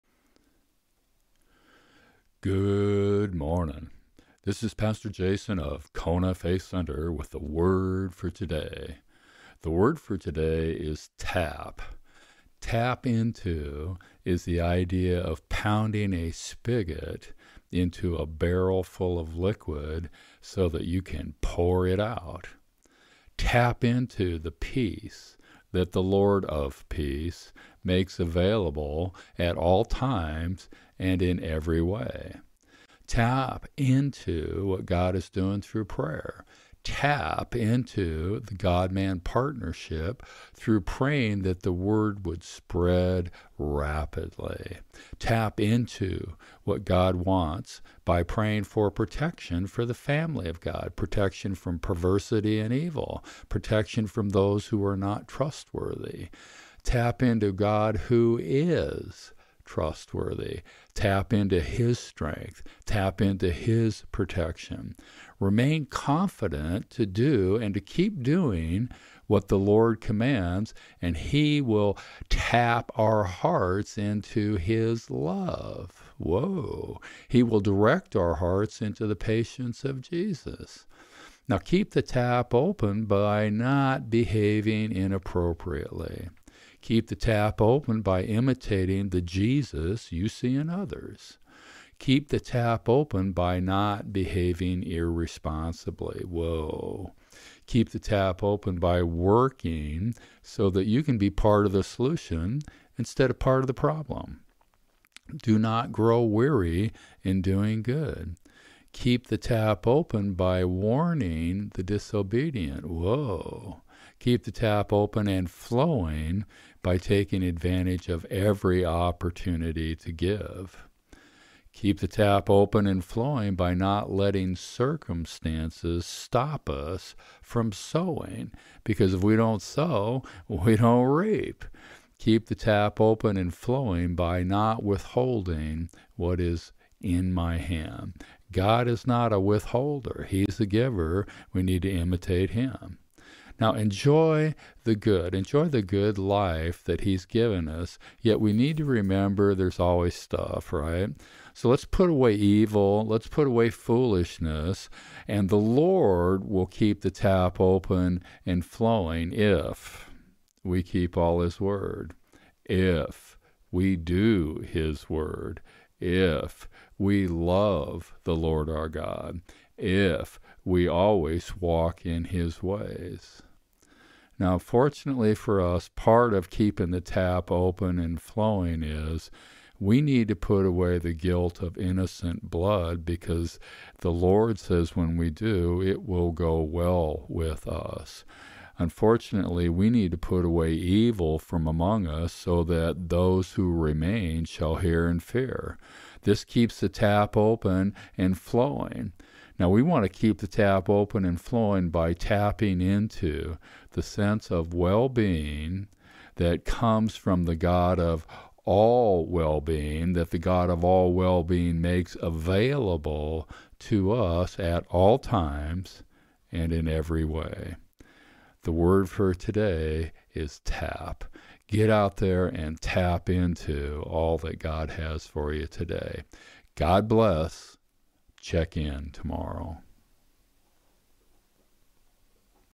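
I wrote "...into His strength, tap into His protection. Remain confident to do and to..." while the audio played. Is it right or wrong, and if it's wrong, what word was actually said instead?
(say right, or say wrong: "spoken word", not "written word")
right.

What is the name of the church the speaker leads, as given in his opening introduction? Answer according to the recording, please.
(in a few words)
Kona Faith Center.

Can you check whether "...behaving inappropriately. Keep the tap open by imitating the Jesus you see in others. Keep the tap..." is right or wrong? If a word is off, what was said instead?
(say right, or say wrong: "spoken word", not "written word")
right.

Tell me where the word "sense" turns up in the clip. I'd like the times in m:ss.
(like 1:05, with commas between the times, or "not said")
3:24.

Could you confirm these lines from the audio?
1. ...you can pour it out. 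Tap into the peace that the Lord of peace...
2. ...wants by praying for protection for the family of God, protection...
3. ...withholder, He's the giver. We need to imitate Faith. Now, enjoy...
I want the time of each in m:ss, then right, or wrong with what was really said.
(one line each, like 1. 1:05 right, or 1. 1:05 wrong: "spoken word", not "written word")
1. 0:20 right
2. 0:47 right
3. 2:19 wrong: "Him", not "Faith".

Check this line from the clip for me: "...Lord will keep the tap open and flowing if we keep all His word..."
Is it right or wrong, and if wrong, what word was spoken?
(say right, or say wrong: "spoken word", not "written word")
right.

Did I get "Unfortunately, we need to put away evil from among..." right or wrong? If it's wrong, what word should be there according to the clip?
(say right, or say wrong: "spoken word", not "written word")
right.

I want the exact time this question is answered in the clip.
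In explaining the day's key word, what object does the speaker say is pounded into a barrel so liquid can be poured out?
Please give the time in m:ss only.
0:16.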